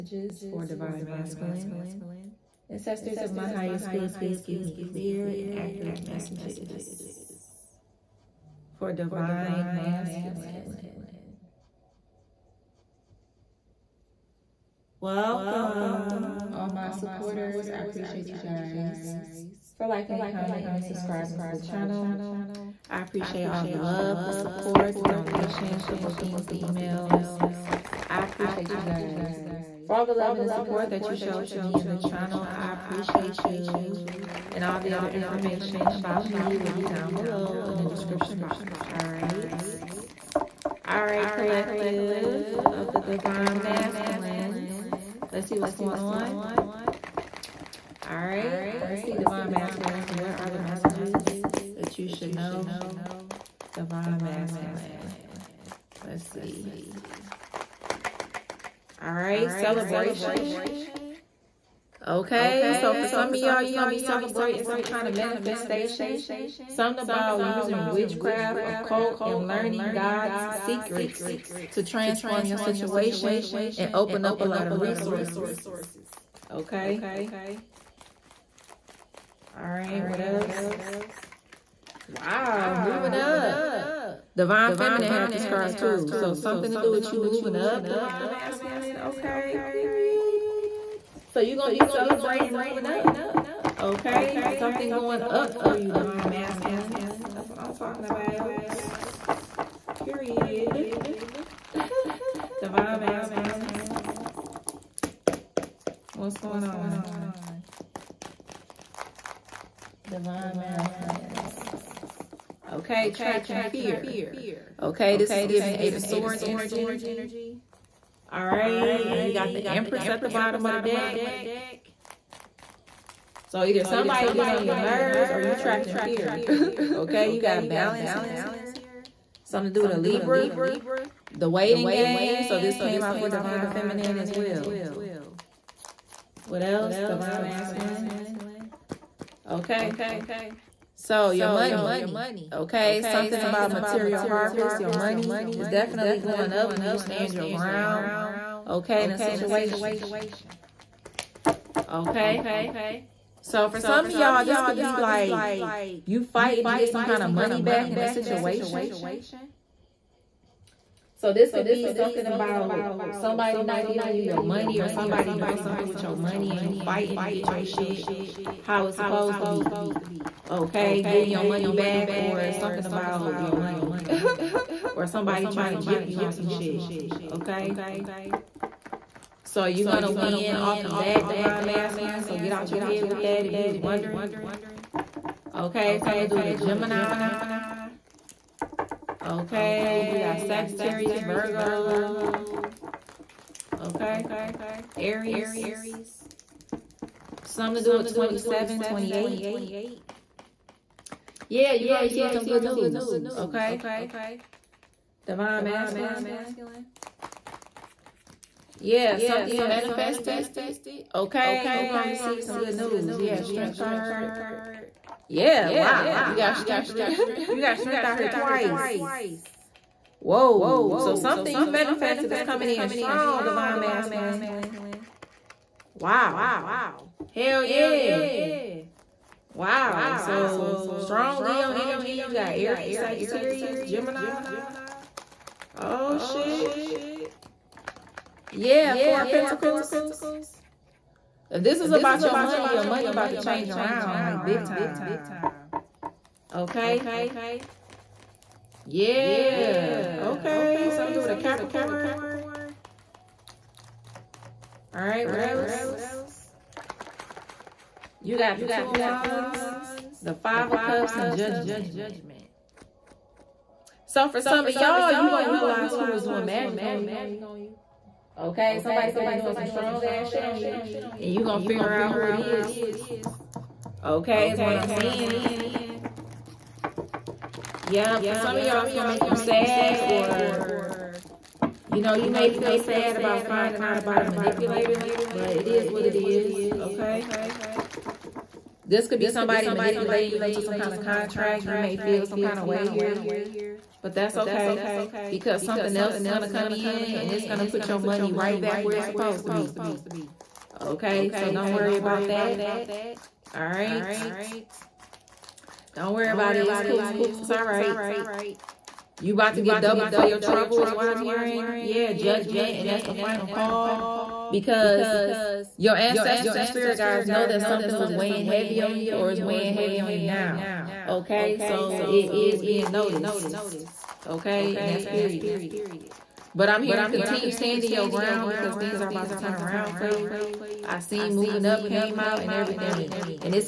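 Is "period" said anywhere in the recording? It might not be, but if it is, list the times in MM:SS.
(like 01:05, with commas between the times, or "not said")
01:29, 01:40, 05:25.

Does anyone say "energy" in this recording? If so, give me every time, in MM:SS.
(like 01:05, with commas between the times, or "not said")
01:56, 03:51.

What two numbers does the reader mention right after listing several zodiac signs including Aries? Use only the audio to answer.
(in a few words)
27, 28.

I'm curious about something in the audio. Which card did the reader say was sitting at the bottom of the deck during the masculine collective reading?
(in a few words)
The Empress.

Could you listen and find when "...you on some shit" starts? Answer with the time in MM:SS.
02:56.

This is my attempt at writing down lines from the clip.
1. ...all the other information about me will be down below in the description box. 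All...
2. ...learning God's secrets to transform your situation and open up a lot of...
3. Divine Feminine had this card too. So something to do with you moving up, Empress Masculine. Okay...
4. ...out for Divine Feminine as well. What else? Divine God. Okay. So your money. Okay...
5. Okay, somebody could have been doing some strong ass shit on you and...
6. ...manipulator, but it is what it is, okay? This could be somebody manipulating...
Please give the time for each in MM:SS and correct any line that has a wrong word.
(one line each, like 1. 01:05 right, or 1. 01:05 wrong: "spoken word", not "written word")
1. 00:34 right
2. 01:09 right
3. 01:24 wrong: "Divine", not "Empress"
4. 02:13 wrong: "Masculine", not "God"
5. 04:28 right
6. 04:44 right.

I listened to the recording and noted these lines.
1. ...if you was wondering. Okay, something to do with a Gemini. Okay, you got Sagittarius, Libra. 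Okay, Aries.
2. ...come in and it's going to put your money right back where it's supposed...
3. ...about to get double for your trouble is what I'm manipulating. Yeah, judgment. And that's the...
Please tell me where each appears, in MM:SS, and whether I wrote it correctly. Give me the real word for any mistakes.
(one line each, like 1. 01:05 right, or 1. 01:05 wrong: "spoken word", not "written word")
1. 03:03 wrong: "Virgo", not "Libra"
2. 04:56 right
3. 05:09 wrong: "hearing", not "manipulating".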